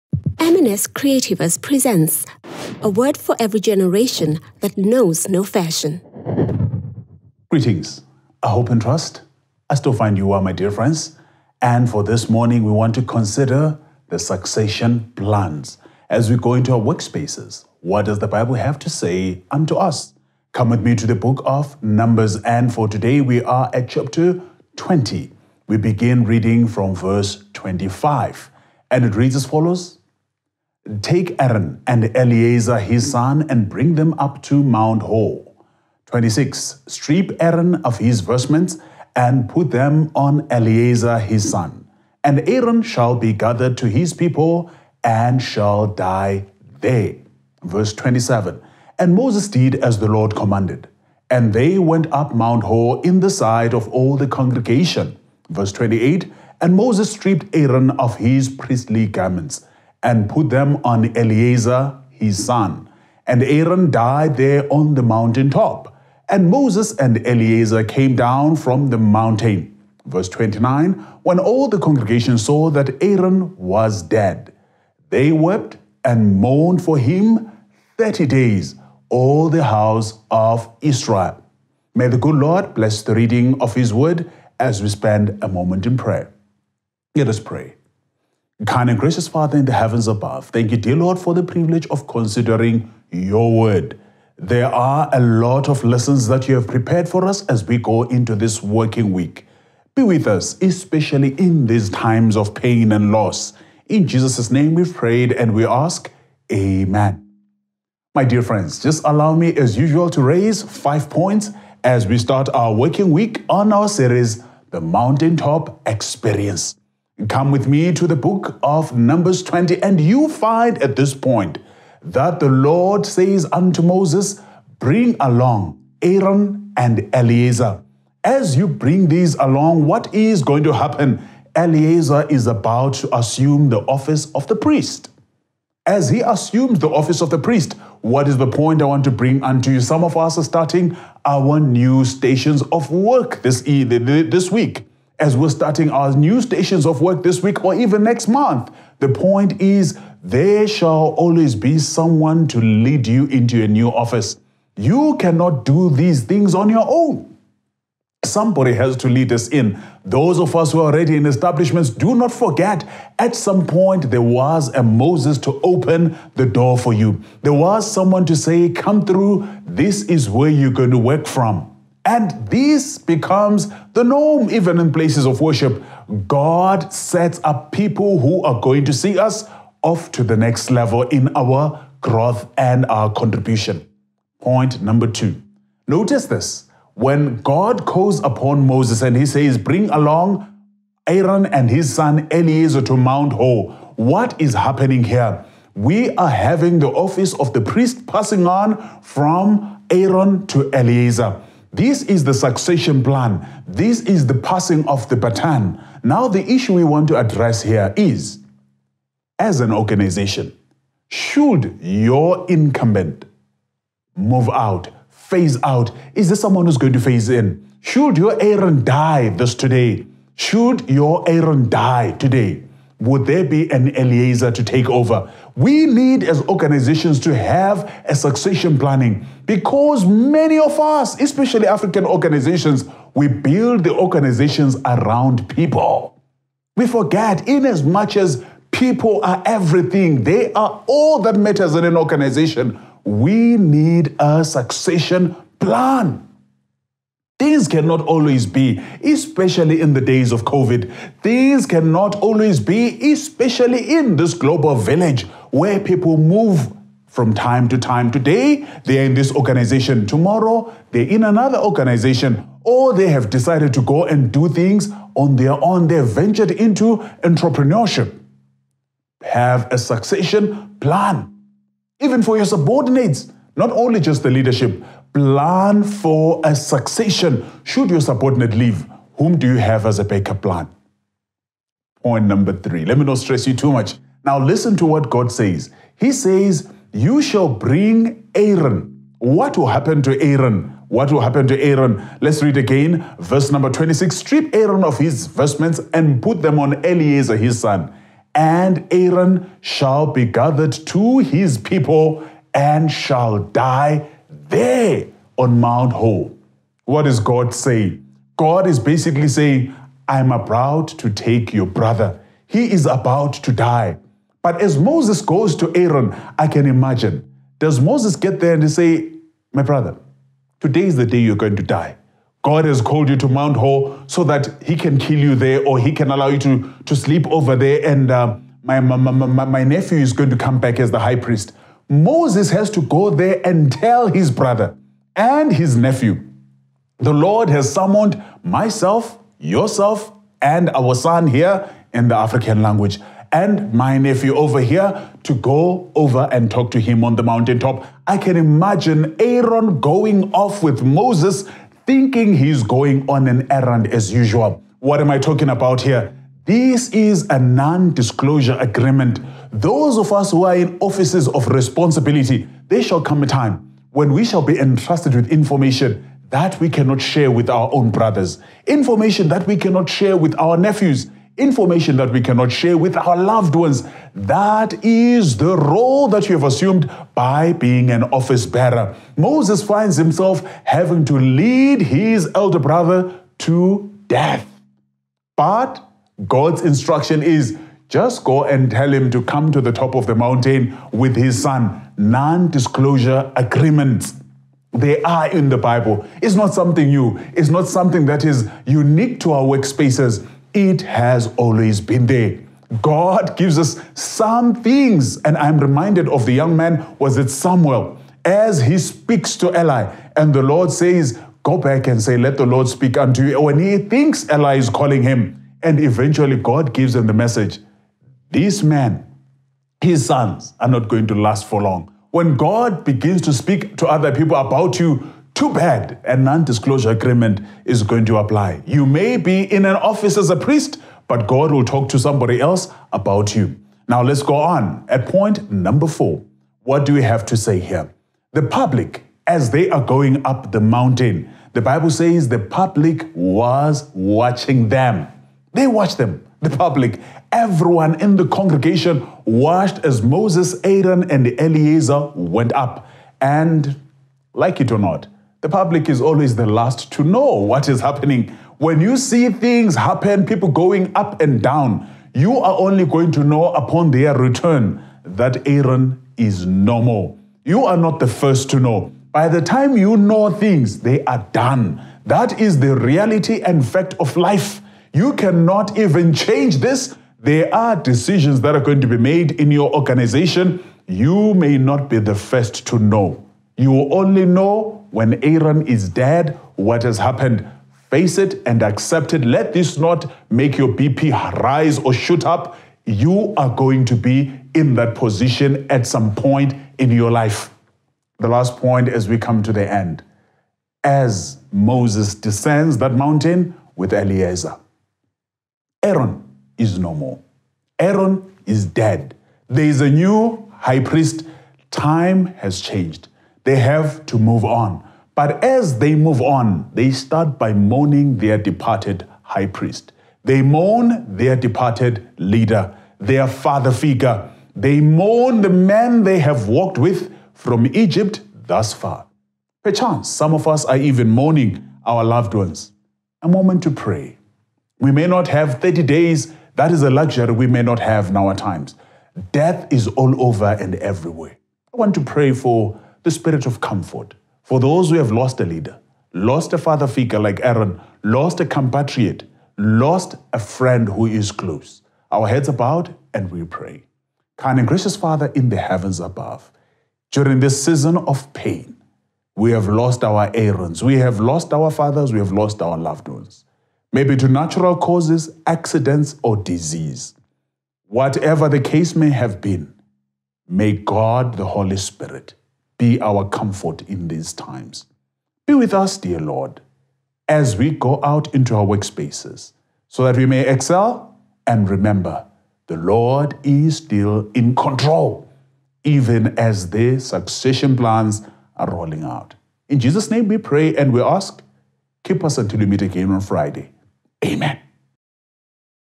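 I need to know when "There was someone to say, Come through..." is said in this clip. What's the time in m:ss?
2:47.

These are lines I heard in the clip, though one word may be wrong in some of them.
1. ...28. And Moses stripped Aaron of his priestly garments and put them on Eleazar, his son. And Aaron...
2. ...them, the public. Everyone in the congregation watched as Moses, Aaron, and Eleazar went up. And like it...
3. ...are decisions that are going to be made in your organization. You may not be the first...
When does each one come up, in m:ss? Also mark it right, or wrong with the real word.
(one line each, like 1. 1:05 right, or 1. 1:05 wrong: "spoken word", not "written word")
1. 0:55 right
2. 7:25 right
3. 7:57 right.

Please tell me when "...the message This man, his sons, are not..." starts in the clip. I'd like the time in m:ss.
6:57.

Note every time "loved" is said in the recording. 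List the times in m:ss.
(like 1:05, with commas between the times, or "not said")
6:13, 8:52, 9:22.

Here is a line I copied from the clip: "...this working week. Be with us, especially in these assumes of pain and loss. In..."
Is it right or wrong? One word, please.
wrong.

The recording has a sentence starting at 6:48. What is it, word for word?
As he speaks to Eli, and the Lord says, Go back and say, Let the Lord speak unto you.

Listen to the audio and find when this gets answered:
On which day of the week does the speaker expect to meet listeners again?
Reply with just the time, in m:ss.
9:53.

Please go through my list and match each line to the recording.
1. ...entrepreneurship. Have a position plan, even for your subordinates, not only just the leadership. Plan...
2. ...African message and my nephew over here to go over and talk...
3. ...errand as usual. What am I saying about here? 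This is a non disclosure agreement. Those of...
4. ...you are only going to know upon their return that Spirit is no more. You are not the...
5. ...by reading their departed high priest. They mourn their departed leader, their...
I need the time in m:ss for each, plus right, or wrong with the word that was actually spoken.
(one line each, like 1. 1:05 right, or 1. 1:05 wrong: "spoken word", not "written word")
1. 4:27 wrong: "succession", not "position"
2. 5:42 wrong: "language", not "message"
3. 5:53 wrong: "talking", not "saying"
4. 7:42 wrong: "Aaron", not "Spirit"
5. 8:37 wrong: "mourning", not "reading".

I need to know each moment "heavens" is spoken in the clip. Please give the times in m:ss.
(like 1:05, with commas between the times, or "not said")
1:29, 9:15.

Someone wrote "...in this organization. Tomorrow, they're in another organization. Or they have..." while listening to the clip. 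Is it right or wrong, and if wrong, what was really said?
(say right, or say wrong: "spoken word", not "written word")
right.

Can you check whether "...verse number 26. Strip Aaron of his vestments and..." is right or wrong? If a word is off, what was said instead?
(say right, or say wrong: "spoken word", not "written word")
right.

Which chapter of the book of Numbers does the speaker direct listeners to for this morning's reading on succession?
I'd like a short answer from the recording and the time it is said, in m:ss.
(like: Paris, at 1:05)
20, at 0:23.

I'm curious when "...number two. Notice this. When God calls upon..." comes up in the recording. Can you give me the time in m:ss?
3:04.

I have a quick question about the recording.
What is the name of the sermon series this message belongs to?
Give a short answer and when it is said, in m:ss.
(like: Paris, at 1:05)
The Mountaintop Experience, at 1:54.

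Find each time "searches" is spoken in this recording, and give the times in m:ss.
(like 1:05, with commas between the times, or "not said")
not said.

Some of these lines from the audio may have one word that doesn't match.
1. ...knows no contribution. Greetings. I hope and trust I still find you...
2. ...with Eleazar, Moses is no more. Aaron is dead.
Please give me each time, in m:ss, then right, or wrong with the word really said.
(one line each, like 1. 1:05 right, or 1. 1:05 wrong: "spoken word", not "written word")
1. 0:04 wrong: "fashion", not "contribution"
2. 8:23 wrong: "Aaron", not "Moses".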